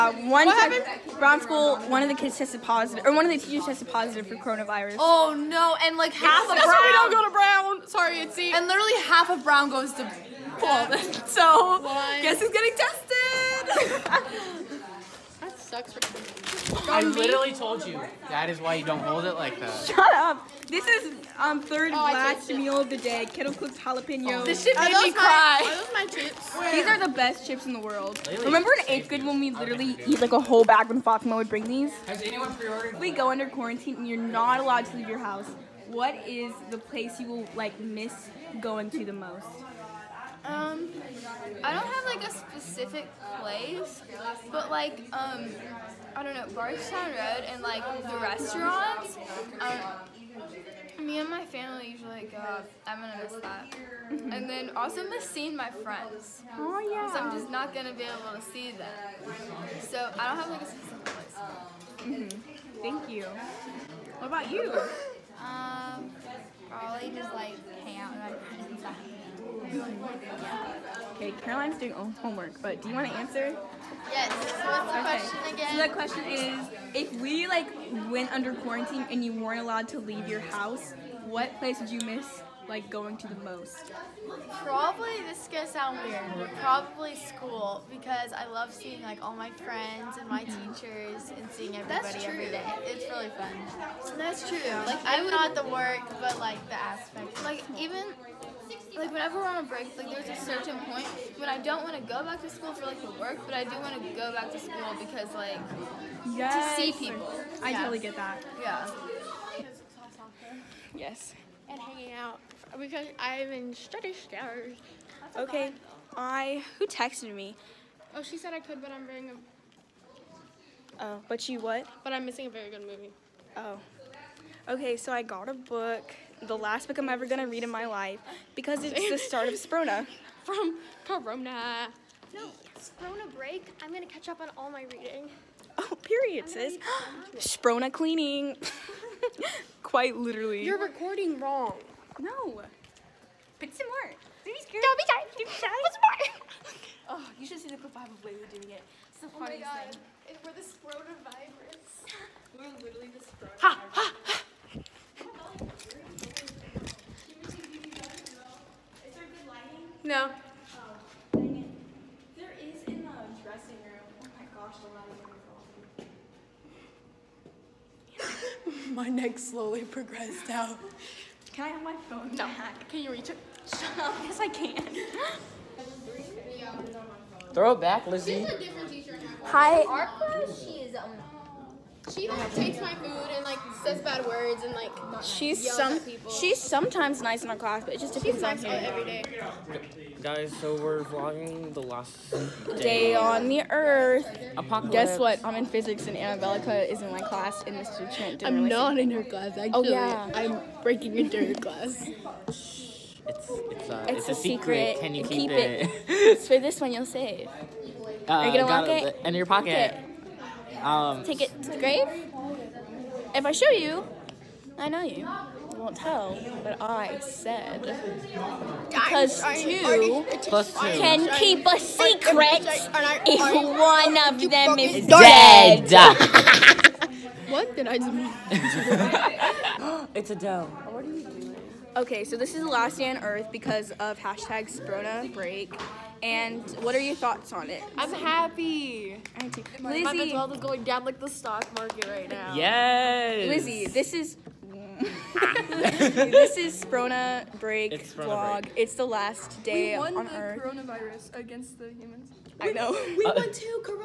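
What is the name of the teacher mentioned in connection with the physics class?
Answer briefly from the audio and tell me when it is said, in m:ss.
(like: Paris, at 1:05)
Mr. Trent, at 3:17.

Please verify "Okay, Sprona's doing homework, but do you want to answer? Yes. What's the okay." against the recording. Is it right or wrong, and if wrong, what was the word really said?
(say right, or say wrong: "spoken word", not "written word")
wrong: "Caroline", not "Sprona".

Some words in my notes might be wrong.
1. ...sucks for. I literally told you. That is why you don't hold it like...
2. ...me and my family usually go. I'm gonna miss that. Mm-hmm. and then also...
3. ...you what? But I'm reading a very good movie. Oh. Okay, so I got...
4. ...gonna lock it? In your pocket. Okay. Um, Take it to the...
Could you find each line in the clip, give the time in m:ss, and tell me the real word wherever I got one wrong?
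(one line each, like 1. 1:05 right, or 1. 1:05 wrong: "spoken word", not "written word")
1. 0:15 right
2. 0:51 right
3. 2:01 wrong: "missing", not "reading"
4. 3:28 right.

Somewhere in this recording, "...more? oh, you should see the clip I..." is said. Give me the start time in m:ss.
2:26.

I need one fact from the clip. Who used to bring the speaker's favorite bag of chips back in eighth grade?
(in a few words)
Fatima.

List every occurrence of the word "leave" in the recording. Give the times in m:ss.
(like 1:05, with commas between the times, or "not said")
0:34, 1:19.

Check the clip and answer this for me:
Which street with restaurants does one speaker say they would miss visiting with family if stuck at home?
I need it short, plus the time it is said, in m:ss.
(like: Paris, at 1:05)
Bardstown Road, at 0:46.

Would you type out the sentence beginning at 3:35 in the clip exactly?
You won't tell, but I said.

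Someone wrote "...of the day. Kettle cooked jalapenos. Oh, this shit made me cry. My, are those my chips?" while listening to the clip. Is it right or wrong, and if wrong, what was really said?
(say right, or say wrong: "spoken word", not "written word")
right.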